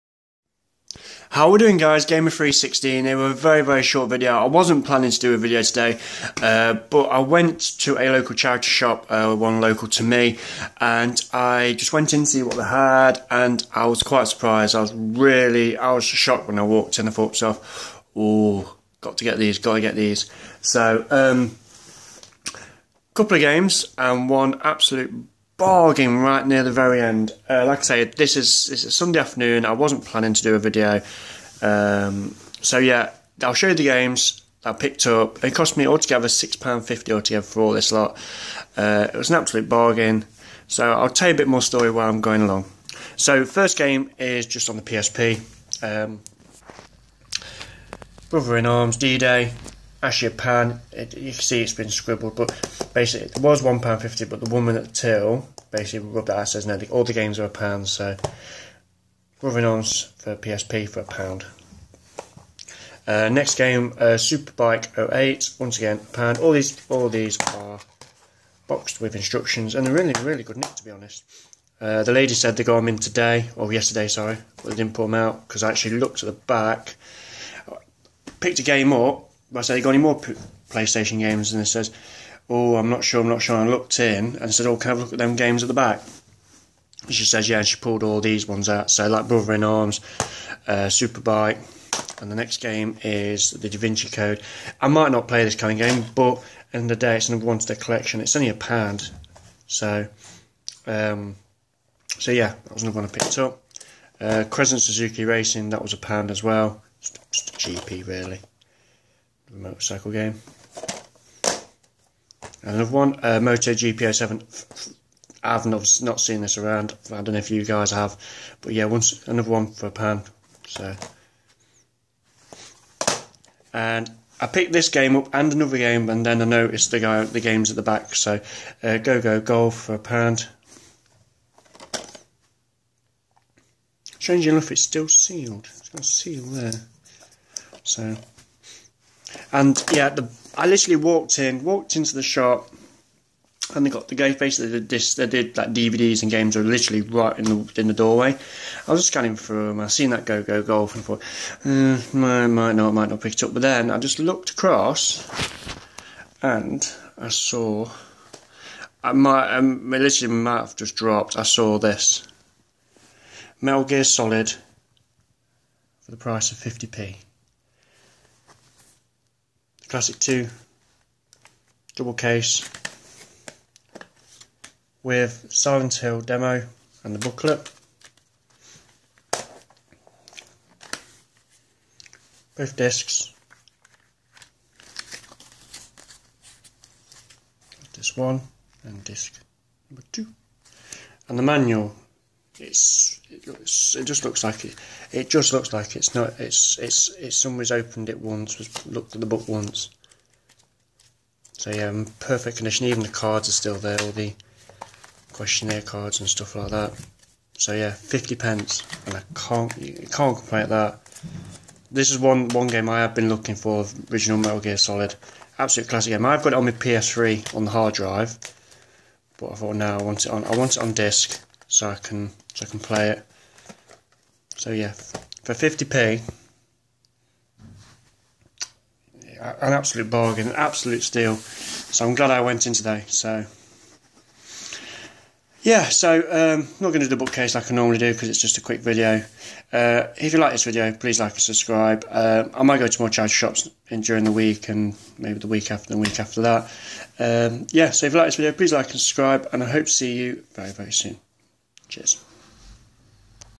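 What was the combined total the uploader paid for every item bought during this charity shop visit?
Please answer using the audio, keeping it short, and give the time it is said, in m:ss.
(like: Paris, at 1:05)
£6.50, at 0:36.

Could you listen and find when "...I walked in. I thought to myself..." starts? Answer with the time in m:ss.
0:16.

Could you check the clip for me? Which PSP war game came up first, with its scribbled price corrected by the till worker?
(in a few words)
Brother in Arms, D-Day.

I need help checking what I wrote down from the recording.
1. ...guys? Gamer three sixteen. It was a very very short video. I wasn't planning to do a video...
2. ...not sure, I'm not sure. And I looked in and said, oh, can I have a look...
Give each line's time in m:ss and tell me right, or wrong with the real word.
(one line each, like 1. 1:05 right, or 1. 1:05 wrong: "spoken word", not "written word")
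1. 0:01 right
2. 1:22 right.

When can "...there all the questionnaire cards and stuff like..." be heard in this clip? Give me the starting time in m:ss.
3:23.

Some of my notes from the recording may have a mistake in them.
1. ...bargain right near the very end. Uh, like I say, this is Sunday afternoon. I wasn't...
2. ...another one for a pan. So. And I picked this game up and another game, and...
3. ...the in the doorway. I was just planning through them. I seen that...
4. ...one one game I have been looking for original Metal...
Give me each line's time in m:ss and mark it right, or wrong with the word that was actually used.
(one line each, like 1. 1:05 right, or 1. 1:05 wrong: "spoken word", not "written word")
1. 0:25 right
2. 1:59 right
3. 2:27 wrong: "scanning", not "planning"
4. 3:32 right.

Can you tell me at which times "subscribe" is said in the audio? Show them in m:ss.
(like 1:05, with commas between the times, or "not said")
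4:01, 4:08.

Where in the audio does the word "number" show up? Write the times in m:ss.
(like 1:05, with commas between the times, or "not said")
1:37, 3:09.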